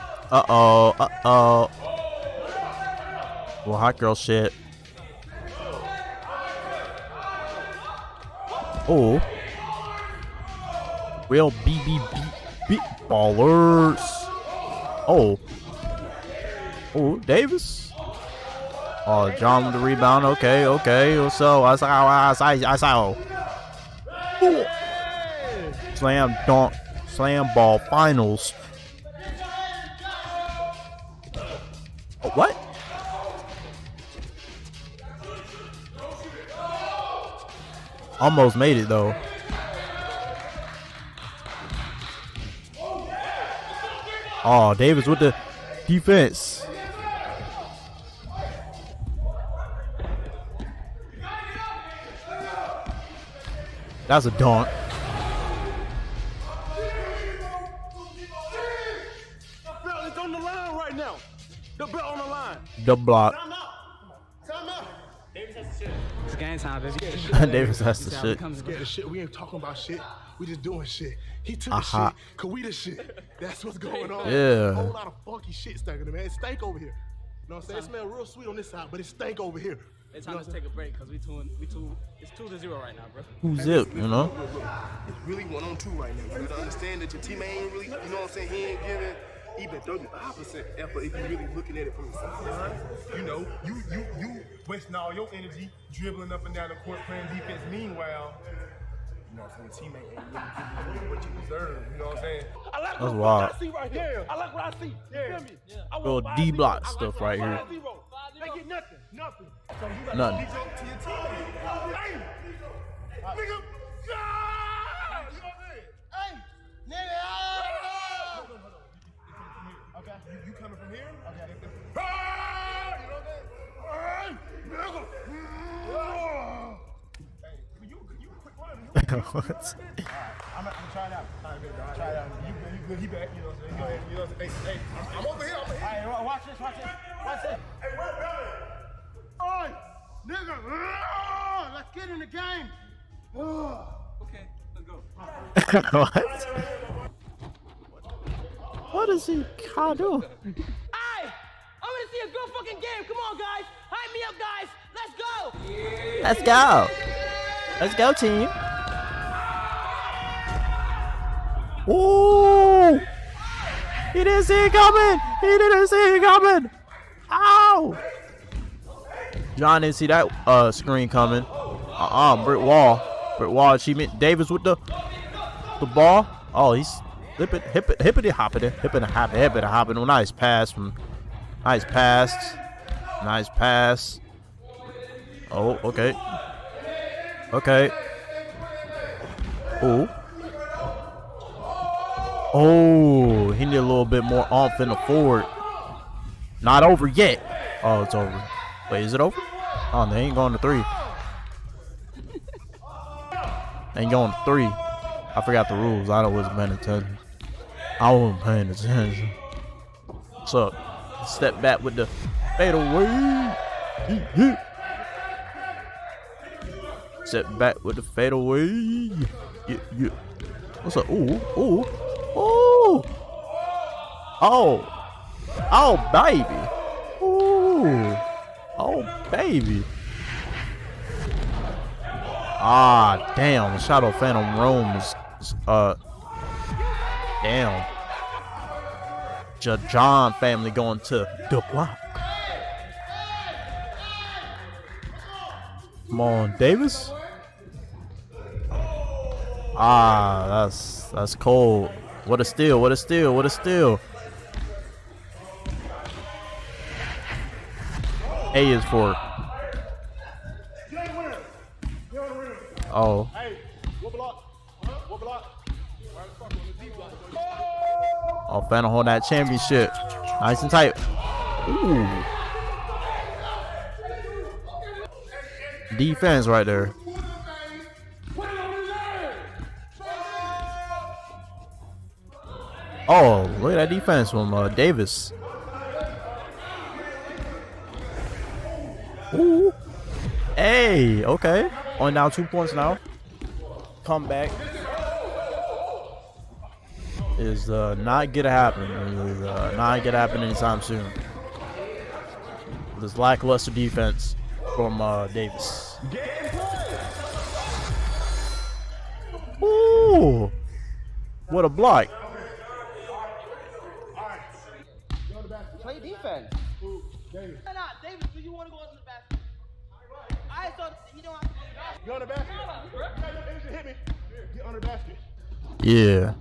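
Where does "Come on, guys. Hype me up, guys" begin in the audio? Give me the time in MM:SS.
02:33.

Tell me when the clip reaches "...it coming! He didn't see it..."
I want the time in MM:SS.
02:44.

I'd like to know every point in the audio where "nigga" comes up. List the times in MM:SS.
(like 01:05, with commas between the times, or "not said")
01:53, 02:20.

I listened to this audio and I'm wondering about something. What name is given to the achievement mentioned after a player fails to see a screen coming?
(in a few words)
Britt Wall.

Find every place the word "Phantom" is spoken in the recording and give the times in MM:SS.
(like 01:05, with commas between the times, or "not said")
03:54.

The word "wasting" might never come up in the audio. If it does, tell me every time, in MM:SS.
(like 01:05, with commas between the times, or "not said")
01:34.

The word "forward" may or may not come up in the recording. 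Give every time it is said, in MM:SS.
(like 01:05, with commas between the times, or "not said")
03:14.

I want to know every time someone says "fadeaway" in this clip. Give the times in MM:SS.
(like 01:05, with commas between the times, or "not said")
03:32, 03:38.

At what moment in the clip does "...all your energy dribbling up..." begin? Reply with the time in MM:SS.
01:34.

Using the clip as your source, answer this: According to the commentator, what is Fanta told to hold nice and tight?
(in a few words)
Championship.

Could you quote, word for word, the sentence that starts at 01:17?
It smell real sweet on this side, but it stank over here.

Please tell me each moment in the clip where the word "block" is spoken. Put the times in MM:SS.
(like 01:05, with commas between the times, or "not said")
01:02, 01:46, 04:01, 05:11.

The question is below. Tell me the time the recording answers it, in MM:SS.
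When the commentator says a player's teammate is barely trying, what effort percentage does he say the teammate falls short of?
01:29.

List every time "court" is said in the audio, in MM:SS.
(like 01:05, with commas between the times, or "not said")
01:36.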